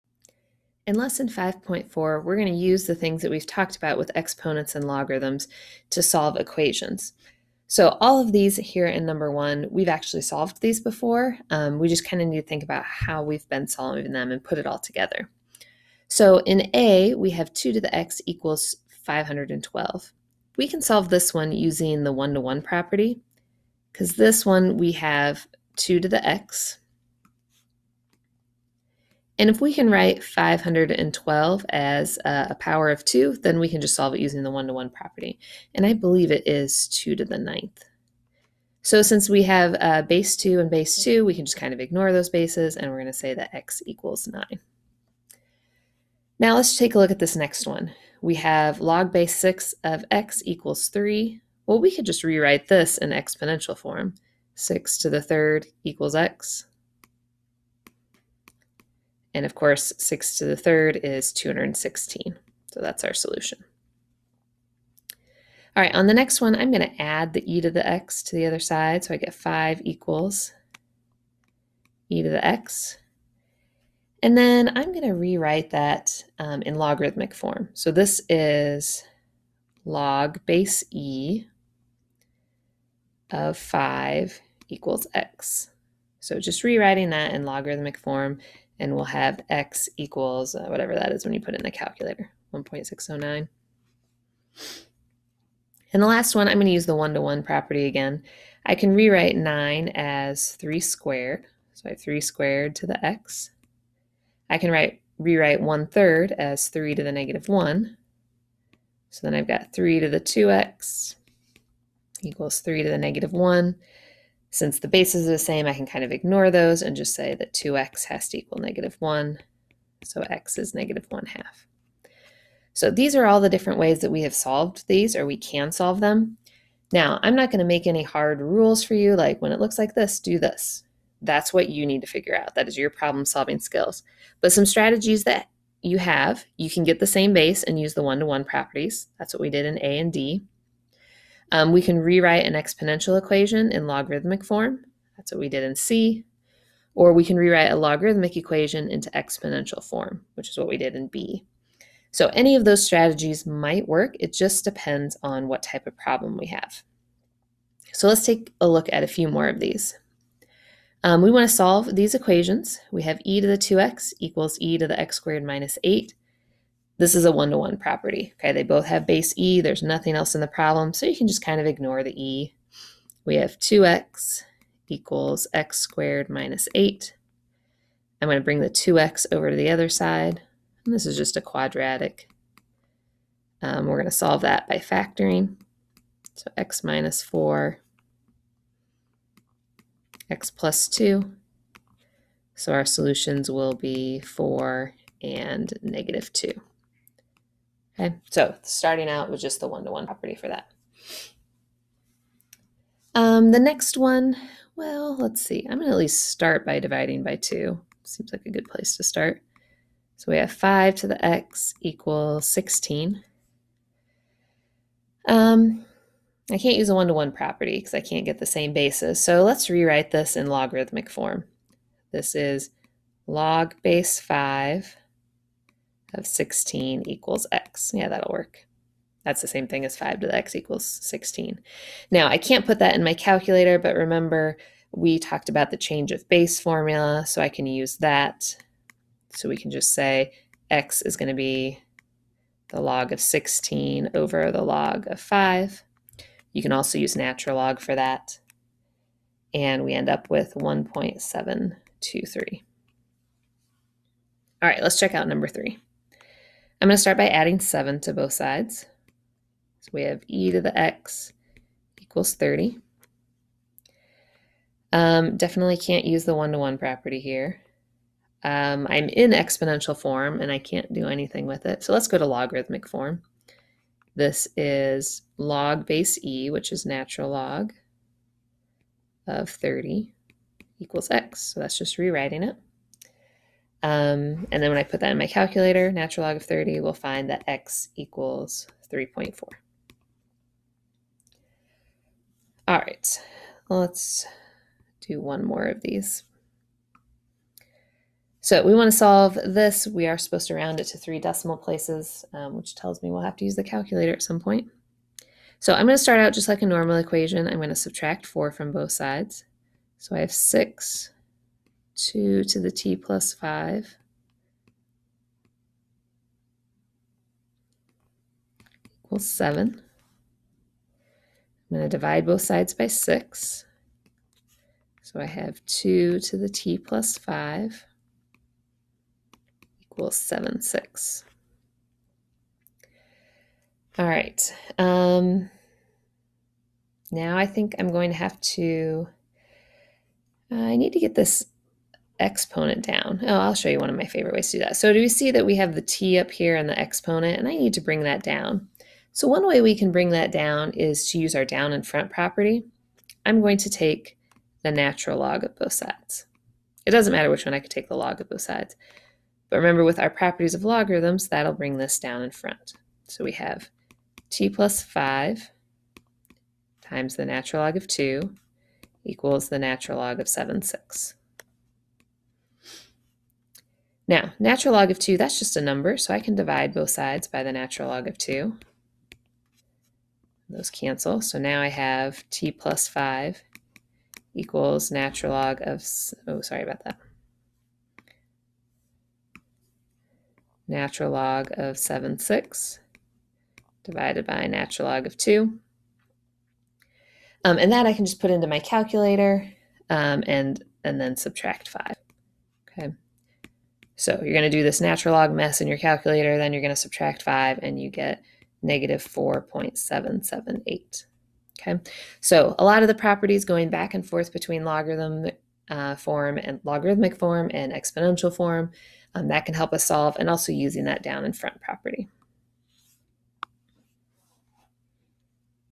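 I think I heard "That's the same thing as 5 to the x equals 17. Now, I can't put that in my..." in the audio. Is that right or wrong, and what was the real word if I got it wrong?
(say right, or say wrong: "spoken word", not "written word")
wrong: "16", not "17".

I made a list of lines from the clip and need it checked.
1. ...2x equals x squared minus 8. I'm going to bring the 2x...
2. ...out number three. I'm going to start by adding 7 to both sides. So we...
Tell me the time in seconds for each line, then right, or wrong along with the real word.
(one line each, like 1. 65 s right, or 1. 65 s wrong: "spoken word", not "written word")
1. 173 s right
2. 255 s right.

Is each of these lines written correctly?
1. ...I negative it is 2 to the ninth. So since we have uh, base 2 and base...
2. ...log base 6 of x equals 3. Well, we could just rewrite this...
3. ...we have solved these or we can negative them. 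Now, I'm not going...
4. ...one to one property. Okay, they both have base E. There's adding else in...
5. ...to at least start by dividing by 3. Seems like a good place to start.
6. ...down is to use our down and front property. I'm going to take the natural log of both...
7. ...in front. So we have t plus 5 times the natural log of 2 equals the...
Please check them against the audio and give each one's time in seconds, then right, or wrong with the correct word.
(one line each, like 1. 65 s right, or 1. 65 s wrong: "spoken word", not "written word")
1. 35 s wrong: "believe", not "negative"
2. 48 s right
3. 124 s wrong: "solve", not "negative"
4. 167 s wrong: "nothing", not "adding"
5. 205 s wrong: "2", not "3"
6. 350 s right
7. 362 s right.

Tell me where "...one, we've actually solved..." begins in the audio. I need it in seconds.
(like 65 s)
9 s.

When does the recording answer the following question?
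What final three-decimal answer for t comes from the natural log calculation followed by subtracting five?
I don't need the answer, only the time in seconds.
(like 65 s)
408 s.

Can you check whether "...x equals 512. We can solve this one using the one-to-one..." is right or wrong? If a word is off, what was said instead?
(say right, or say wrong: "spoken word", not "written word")
right.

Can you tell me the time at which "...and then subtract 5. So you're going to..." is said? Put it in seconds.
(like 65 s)
400 s.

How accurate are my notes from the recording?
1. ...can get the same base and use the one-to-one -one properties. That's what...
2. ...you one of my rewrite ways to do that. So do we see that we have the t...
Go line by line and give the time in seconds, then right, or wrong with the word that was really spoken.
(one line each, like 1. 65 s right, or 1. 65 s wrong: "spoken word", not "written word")
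1. 136 s right
2. 343 s wrong: "favorite", not "rewrite".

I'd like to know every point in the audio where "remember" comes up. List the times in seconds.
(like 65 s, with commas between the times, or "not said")
233 s, 359 s.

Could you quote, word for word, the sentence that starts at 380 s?
Those cancel, so now I have t plus 5 equals natural log of, oh, sorry about that.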